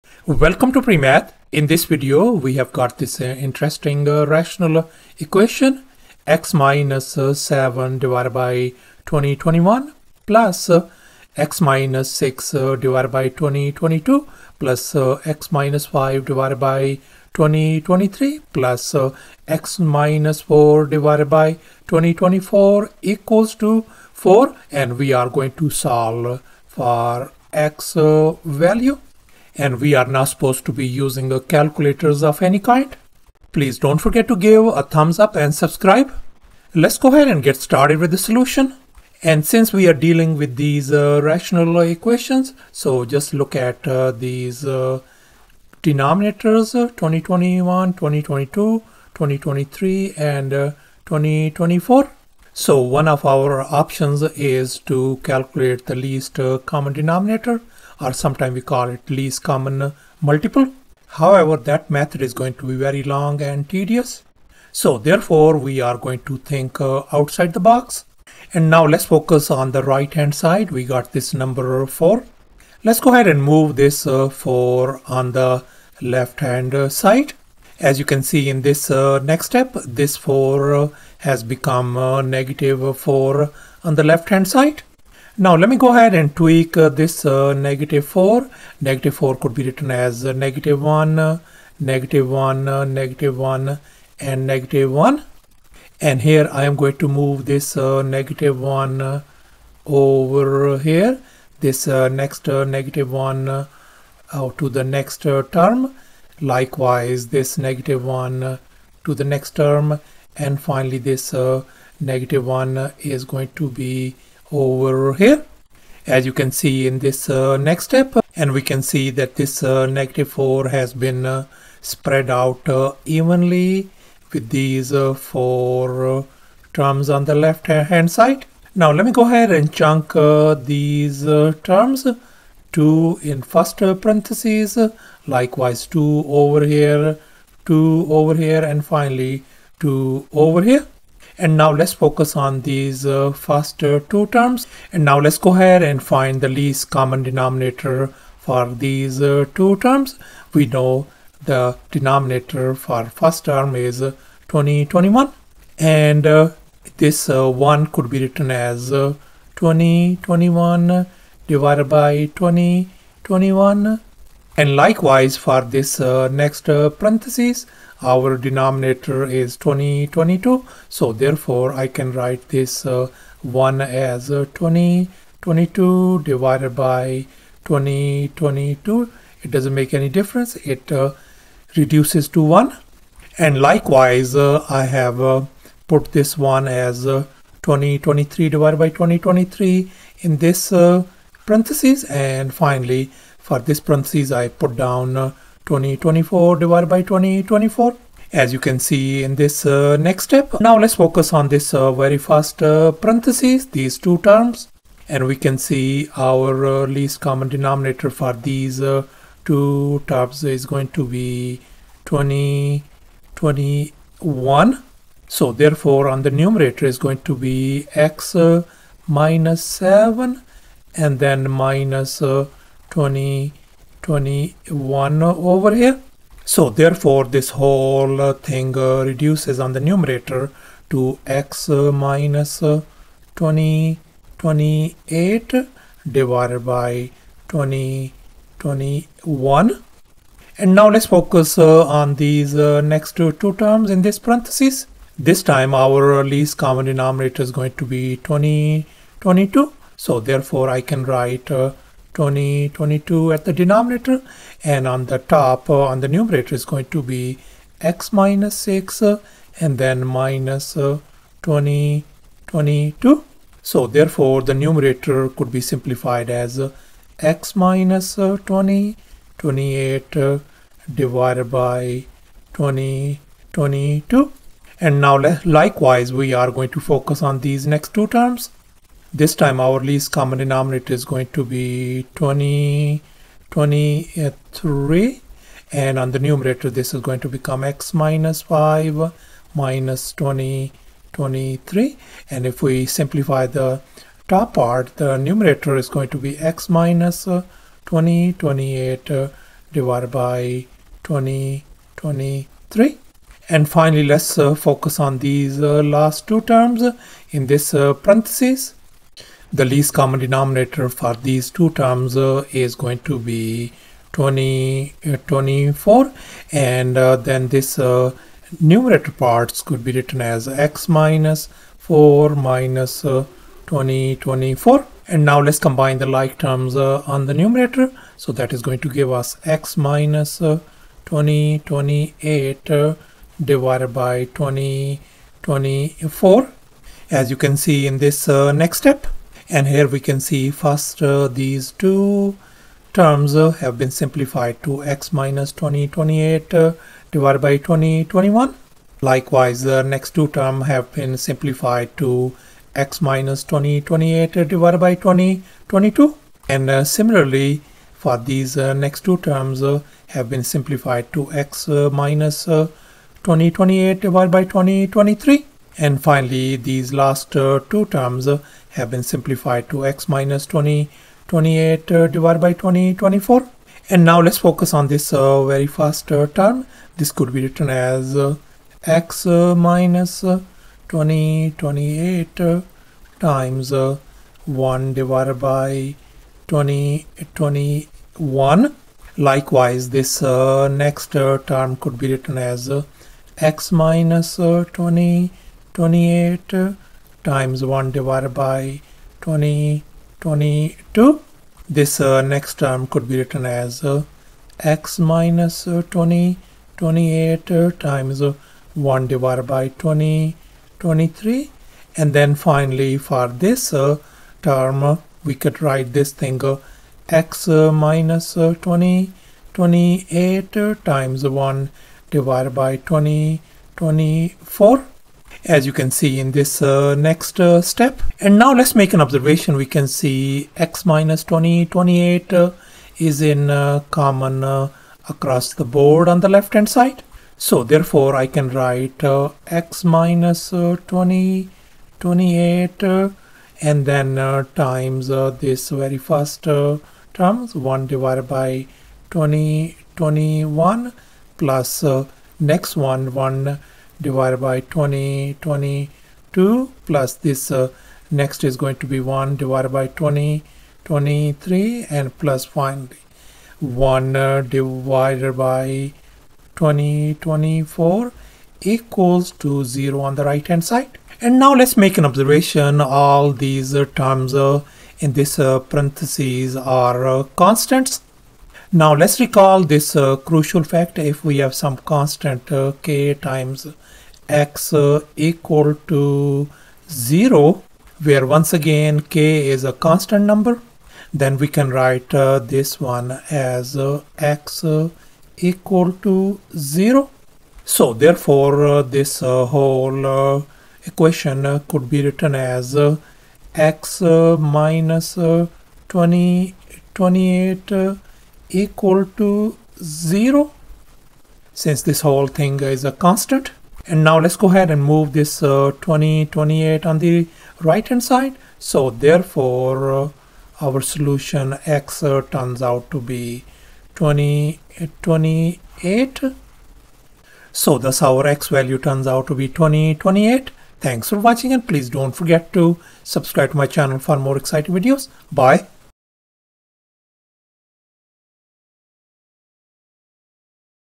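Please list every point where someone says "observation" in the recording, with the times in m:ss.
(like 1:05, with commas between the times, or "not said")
7:09, 7:52.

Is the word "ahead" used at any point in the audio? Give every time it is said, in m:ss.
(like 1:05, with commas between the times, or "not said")
0:37, 1:13, 1:25, 2:09, 2:25, 8:34.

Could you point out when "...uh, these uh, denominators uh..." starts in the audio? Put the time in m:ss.
0:43.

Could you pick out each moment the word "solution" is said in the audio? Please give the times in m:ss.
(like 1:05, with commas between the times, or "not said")
0:38, 8:40.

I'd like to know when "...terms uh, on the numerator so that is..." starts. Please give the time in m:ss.
5:26.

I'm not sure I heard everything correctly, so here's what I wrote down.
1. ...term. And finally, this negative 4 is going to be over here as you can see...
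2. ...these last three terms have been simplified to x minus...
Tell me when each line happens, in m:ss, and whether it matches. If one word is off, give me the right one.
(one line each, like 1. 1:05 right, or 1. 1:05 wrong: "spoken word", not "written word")
1. 1:49 wrong: "1", not "4"
2. 6:06 wrong: "two", not "three".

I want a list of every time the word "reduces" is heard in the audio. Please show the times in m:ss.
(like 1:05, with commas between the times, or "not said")
3:01, 3:49.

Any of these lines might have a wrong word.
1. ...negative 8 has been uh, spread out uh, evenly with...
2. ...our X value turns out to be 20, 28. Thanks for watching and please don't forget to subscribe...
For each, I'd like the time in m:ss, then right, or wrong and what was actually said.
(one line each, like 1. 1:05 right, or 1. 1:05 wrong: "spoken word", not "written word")
1. 1:59 wrong: "4", not "8"
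2. 8:48 right.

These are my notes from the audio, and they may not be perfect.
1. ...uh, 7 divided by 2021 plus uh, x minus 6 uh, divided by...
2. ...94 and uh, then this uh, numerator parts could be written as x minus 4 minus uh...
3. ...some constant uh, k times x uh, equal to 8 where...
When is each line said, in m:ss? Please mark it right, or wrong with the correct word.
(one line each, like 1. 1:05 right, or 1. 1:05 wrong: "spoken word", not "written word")
1. 0:07 right
2. 5:15 wrong: "24", not "94"
3. 8:01 wrong: "0", not "8".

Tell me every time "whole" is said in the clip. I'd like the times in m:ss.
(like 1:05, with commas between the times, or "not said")
3:47, 8:19, 8:32.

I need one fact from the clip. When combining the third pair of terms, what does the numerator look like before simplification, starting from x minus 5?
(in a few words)
x minus 5 minus 2023.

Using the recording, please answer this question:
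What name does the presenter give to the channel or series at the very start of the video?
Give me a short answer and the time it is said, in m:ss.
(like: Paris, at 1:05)
PreMath, at 0:00.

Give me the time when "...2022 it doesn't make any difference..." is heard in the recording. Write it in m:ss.
2:57.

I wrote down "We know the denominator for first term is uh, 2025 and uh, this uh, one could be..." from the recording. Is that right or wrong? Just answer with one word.
wrong.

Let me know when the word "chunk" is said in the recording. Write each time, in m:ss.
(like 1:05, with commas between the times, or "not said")
2:09.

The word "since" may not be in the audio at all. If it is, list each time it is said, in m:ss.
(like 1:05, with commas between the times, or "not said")
0:39, 8:31.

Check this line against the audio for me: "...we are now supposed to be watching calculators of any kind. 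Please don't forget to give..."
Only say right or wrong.
wrong.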